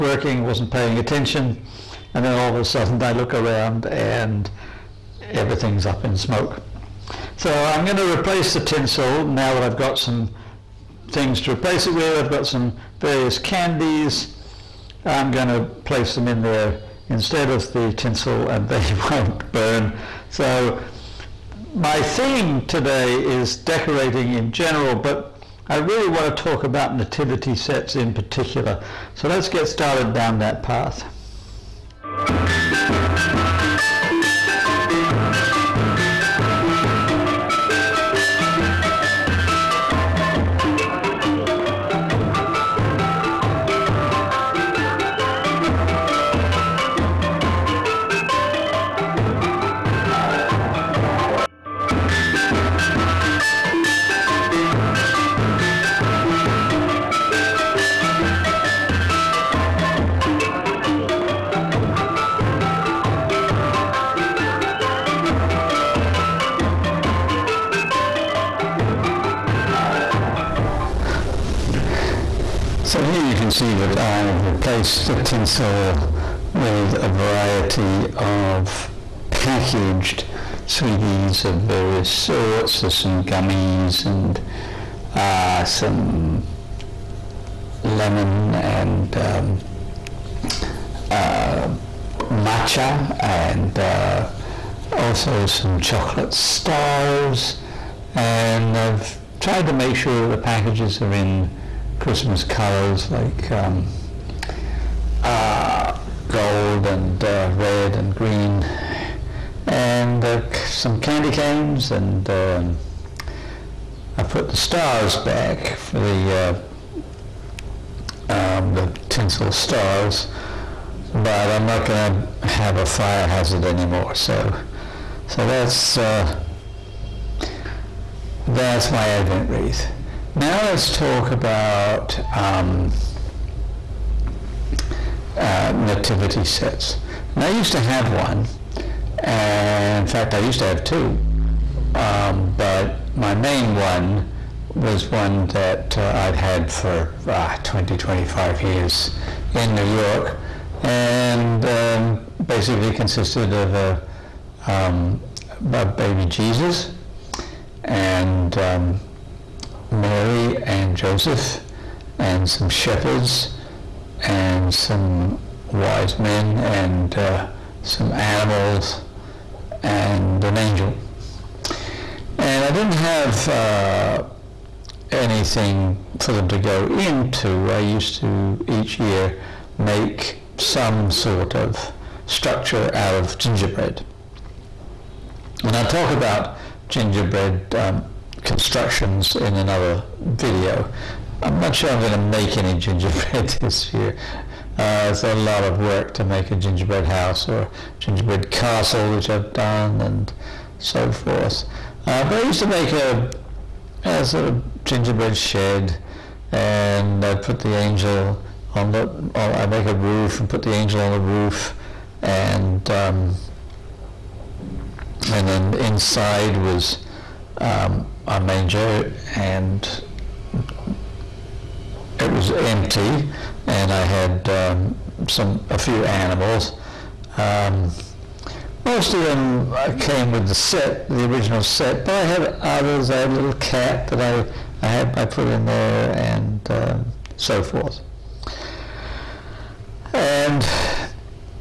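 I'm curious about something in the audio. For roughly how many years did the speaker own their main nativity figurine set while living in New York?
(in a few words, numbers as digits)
20, 25.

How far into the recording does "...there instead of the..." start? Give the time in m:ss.
0:16.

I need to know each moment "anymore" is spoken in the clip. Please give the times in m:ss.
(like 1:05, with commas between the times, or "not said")
2:03.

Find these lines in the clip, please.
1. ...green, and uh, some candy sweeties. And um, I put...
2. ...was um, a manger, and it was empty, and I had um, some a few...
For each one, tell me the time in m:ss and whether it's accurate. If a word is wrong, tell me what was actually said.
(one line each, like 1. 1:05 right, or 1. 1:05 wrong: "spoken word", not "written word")
1. 1:48 wrong: "canes", not "sweeties"
2. 3:36 right.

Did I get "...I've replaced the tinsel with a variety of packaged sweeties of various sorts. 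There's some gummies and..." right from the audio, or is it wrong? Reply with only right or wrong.
right.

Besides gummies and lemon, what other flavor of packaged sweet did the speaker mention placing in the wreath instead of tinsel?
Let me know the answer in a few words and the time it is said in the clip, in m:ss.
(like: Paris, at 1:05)
matcha, at 1:32.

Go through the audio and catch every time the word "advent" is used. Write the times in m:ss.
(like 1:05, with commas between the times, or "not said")
2:09.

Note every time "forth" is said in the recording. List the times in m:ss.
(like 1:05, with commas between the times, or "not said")
3:21, 3:57.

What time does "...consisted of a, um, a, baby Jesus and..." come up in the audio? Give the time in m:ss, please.
2:32.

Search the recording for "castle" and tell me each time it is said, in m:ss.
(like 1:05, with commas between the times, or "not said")
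3:18.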